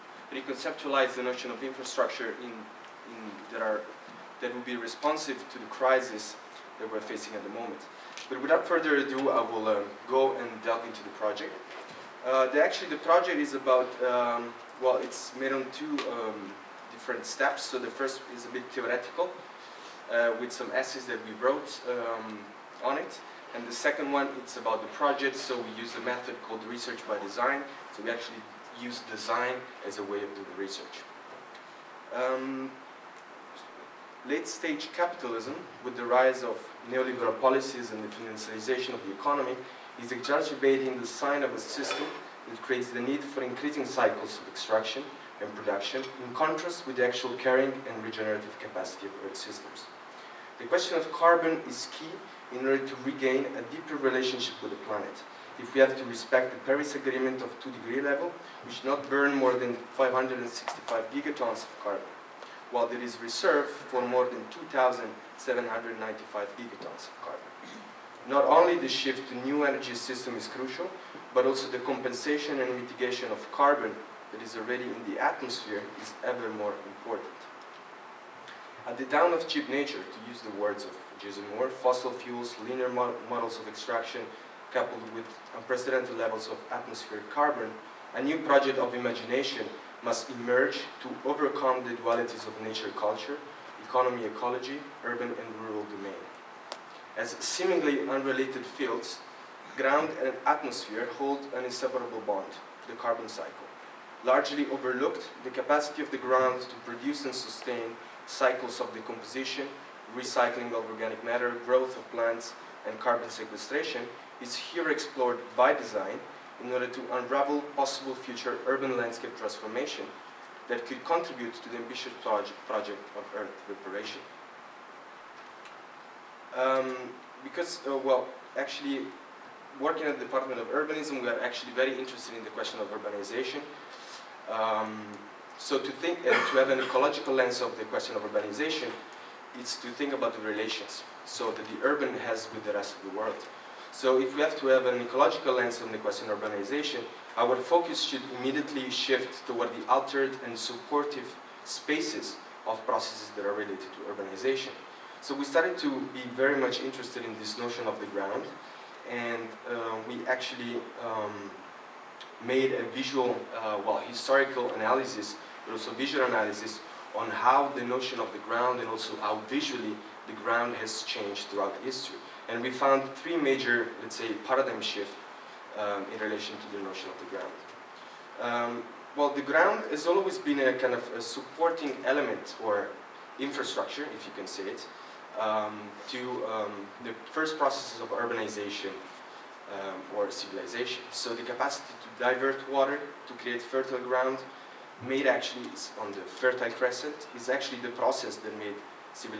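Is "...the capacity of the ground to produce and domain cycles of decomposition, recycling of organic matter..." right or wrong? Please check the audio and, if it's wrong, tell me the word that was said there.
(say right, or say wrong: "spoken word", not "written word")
wrong: "sustain", not "domain".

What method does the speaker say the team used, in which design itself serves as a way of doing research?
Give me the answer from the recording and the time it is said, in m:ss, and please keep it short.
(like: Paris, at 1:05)
research by design, at 0:26.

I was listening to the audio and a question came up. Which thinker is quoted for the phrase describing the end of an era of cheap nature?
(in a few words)
Jason Moore.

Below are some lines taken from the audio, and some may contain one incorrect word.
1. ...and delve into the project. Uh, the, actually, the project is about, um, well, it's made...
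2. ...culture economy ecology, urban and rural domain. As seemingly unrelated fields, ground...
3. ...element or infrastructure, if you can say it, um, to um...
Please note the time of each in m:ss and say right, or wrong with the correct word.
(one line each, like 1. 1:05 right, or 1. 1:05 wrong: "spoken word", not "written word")
1. 0:10 right
2. 1:32 right
3. 3:02 right.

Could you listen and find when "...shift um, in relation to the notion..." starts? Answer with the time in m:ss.
2:54.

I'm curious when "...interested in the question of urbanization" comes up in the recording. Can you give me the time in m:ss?
2:11.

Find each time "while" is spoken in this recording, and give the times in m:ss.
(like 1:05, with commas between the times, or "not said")
1:02.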